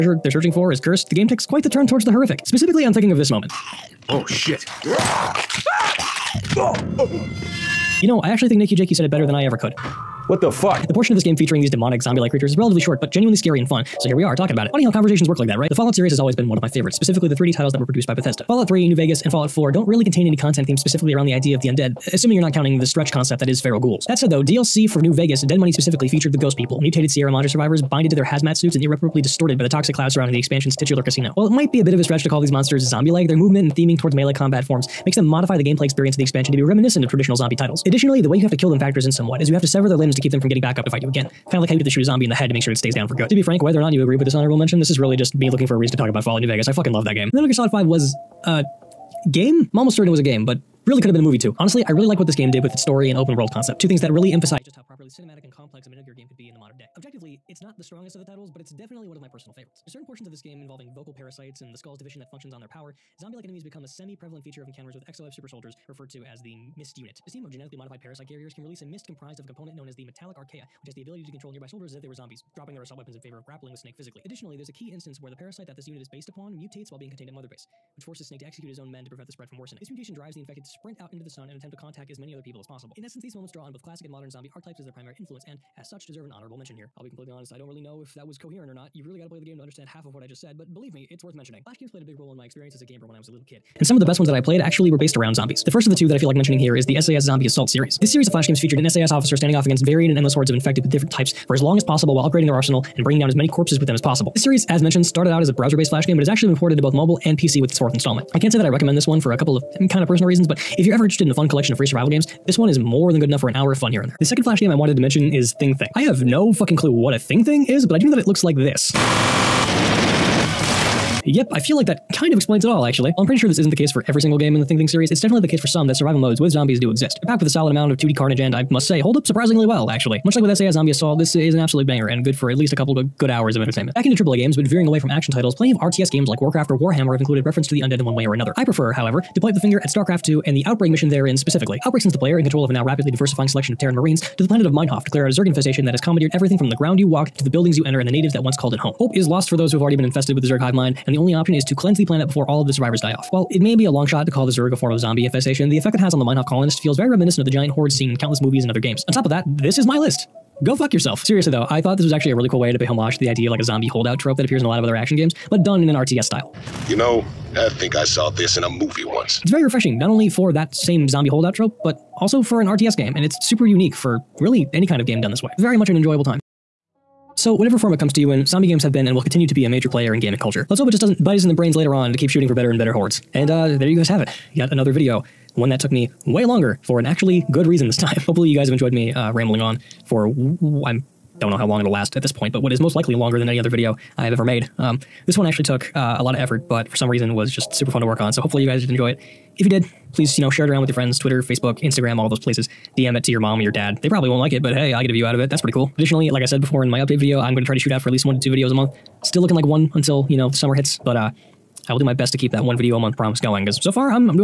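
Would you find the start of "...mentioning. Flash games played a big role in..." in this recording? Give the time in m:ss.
1:31.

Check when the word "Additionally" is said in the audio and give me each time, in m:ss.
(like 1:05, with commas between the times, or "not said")
0:37, 1:14, 3:25.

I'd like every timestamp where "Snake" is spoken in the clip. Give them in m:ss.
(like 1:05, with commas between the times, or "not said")
1:13, 1:18.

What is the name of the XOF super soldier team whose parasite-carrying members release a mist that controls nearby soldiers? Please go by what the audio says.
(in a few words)
Mist Unit.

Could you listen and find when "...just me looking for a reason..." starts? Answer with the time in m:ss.
0:45.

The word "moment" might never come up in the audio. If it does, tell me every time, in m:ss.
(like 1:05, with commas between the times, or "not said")
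0:03, 1:23.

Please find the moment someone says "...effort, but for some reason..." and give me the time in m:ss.
3:16.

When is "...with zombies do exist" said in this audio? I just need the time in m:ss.
2:06.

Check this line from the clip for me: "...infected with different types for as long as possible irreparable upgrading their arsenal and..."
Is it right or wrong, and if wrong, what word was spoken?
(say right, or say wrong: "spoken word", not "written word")
wrong: "while", not "irreparable".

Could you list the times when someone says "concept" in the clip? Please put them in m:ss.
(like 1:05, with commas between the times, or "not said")
0:23, 0:53.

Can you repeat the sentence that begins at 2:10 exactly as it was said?
Much like with SAS Zombie Assault, this is an absolute banger and good for at least a couple good hours of entertainment.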